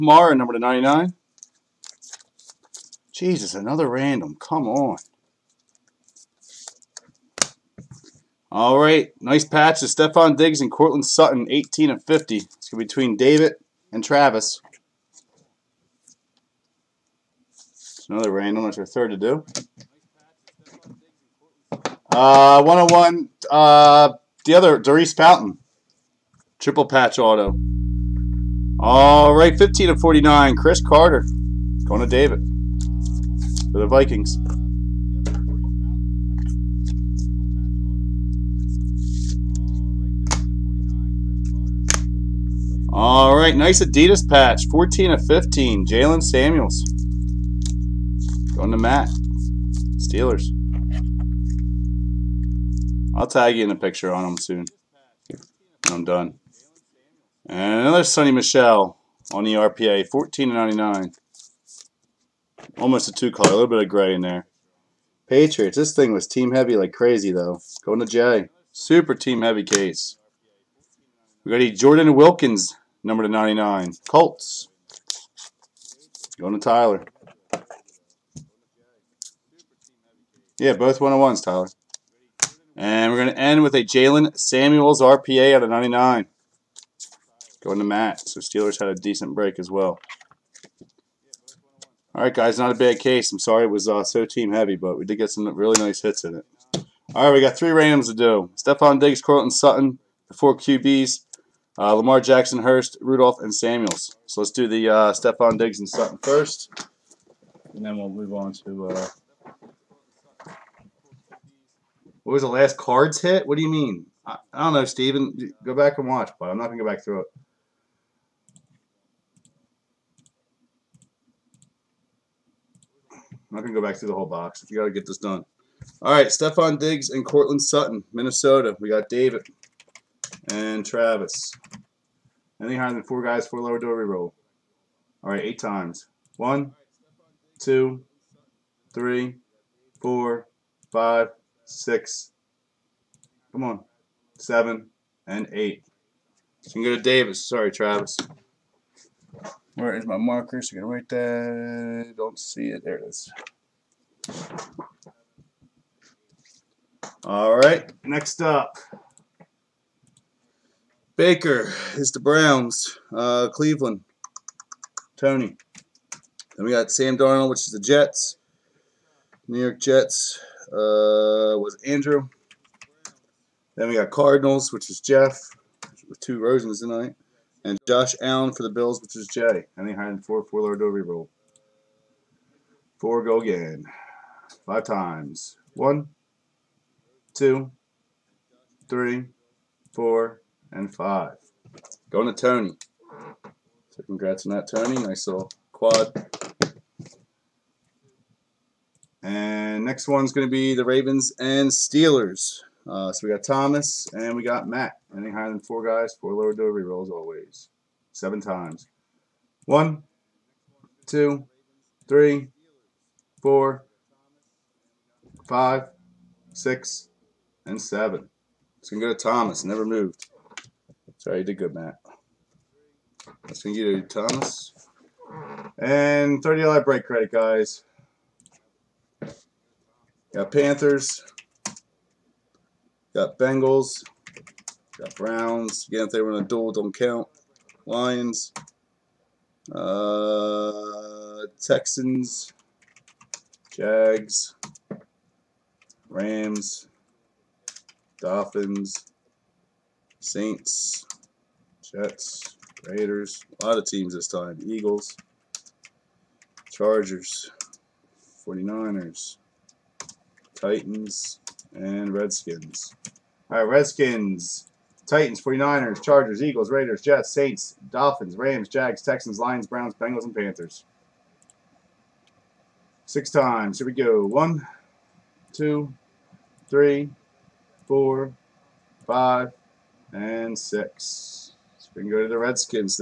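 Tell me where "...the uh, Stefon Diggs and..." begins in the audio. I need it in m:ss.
1:44.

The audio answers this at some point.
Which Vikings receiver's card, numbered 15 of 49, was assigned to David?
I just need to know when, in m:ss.
0:30.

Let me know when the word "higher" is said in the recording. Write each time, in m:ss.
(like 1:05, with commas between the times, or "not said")
2:12, 3:25.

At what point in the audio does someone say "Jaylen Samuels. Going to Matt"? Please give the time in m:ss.
0:45.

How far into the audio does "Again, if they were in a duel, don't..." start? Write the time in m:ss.
3:55.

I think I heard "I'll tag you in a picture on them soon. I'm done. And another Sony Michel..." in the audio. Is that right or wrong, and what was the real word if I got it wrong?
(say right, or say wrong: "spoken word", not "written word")
right.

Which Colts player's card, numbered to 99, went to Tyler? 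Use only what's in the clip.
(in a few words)
Jordan Wilkins.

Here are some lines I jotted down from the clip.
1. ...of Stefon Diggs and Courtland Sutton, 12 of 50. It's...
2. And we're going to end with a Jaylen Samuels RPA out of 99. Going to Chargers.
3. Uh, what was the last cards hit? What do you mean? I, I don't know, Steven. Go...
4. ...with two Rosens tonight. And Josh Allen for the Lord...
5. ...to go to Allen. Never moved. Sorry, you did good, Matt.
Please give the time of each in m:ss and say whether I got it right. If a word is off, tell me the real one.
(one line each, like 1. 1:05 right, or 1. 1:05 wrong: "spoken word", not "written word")
1. 0:09 wrong: "18", not "12"
2. 1:22 wrong: "Matt", not "Chargers"
3. 1:48 right
4. 2:56 wrong: "Bills", not "Lord"
5. 3:39 wrong: "Thomas", not "Allen".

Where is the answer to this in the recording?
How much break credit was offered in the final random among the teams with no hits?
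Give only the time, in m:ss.
3:46.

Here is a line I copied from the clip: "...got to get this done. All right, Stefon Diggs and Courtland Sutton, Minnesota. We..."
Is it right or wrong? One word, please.
right.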